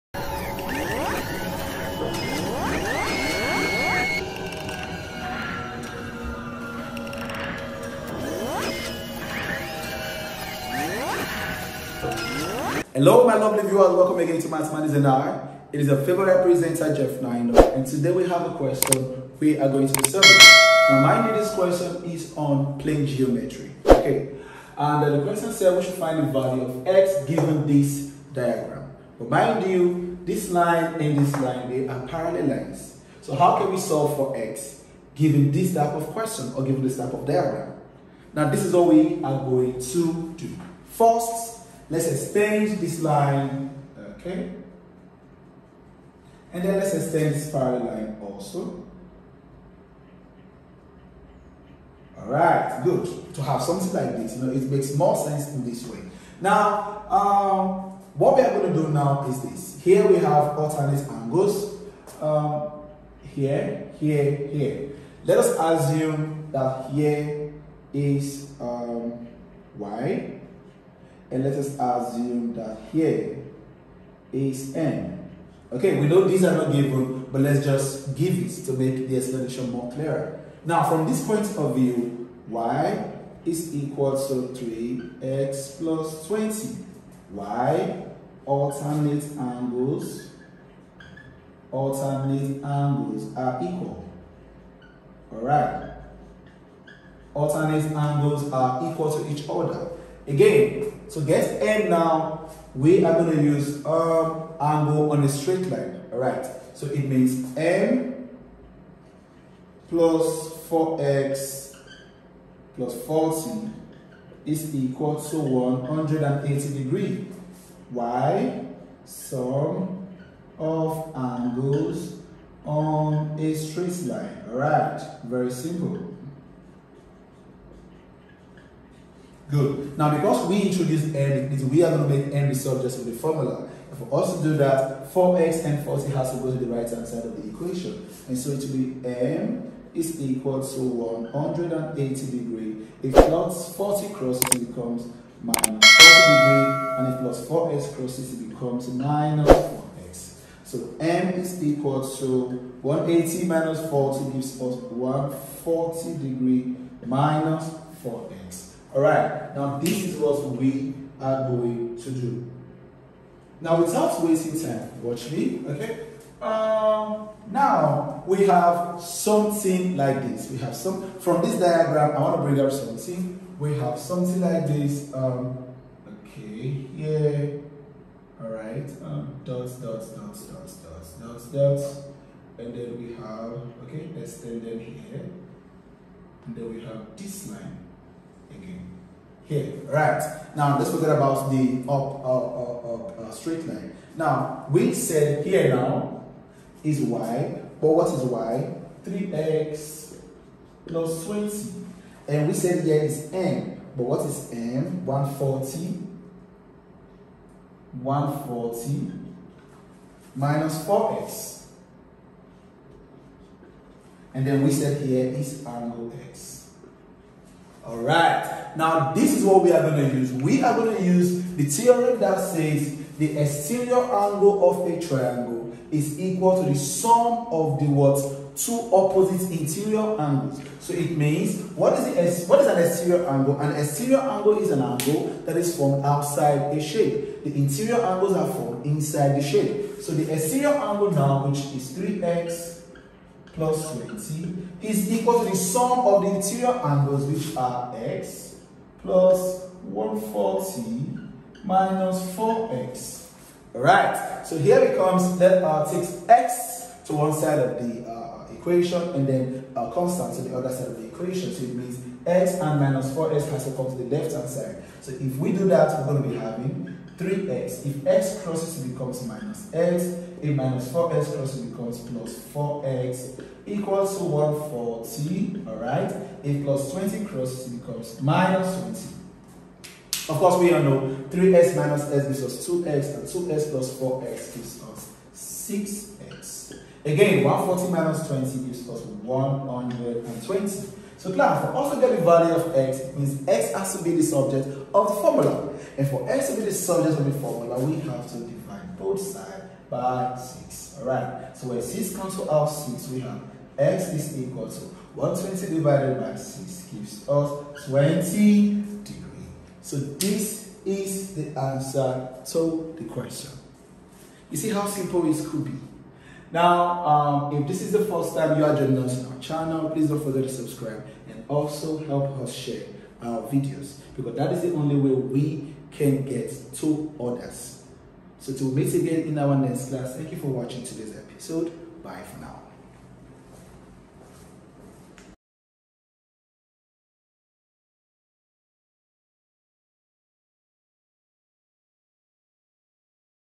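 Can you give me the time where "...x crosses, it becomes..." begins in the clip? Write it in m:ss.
4:28.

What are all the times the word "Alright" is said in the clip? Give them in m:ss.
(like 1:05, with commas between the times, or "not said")
1:35, 4:13, 5:01.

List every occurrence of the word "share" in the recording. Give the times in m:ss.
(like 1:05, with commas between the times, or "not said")
5:22.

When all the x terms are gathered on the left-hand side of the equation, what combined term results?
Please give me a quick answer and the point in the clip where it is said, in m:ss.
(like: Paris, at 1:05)
6x, at 4:45.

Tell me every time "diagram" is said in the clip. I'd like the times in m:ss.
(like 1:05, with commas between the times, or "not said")
0:28, 0:37, 2:51.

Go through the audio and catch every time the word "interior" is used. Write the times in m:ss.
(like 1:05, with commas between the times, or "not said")
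3:49, 3:57, 4:06.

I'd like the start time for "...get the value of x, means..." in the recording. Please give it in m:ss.
4:52.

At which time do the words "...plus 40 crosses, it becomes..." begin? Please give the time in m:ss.
2:23.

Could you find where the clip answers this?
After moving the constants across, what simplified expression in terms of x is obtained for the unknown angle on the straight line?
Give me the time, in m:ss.
2:34.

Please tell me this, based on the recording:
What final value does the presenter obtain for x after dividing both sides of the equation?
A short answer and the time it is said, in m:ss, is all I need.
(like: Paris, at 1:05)
20 degrees, at 5:07.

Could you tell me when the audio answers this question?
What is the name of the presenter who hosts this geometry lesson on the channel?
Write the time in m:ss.
0:16.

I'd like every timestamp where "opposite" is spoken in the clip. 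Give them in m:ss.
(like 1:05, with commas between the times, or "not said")
3:48.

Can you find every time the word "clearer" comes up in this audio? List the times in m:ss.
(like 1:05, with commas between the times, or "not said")
1:19.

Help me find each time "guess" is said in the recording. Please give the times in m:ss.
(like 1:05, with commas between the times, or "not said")
1:41.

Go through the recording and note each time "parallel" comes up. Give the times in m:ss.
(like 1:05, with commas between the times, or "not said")
0:32, 0:47.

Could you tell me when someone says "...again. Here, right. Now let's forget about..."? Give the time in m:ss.
3:08.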